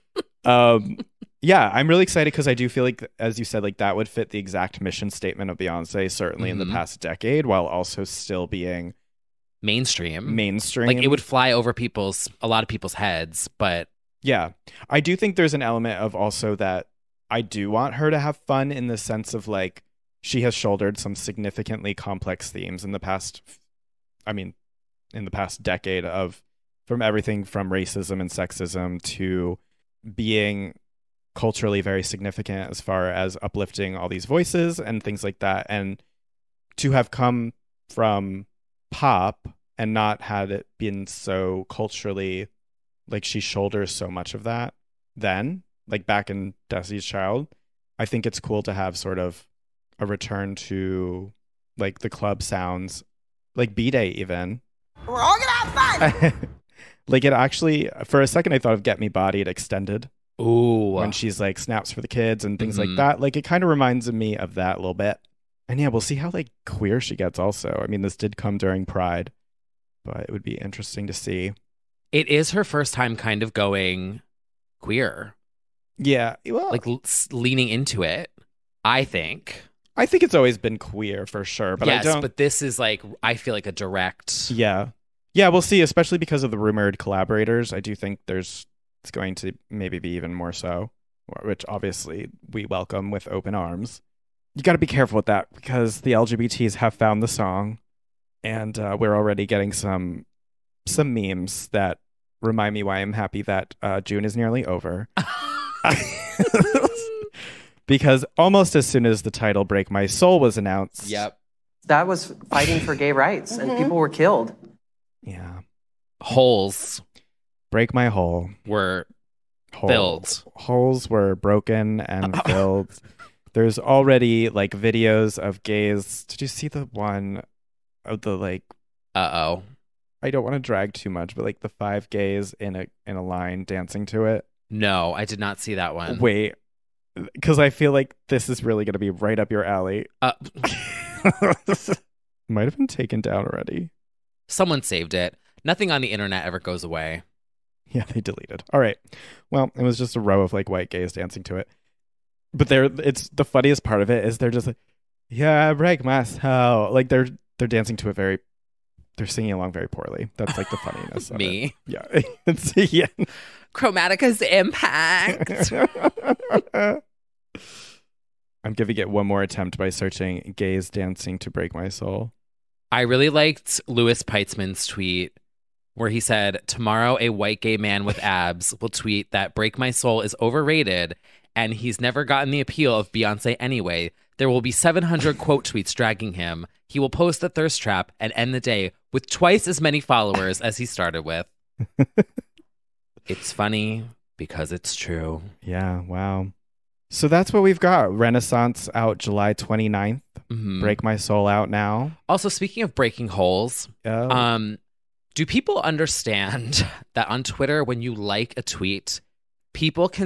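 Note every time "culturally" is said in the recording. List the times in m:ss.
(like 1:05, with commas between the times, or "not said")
0:31, 0:41.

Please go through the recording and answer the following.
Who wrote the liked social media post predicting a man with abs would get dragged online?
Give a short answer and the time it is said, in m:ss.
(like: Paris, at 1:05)
Louis Peitzman, at 2:53.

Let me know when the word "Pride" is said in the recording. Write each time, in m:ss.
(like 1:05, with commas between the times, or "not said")
1:08.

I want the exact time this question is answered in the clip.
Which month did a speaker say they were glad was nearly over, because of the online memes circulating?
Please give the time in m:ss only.
1:44.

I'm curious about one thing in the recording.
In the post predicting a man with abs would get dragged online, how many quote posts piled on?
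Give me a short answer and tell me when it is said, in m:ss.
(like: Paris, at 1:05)
700, at 3:04.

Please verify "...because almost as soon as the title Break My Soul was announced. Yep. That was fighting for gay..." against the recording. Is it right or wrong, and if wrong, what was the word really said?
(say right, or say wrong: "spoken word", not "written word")
right.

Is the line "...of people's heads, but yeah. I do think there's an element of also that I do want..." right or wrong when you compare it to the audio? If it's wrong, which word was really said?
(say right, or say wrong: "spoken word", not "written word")
right.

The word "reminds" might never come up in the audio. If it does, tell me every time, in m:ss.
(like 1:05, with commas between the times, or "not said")
1:03, 1:42.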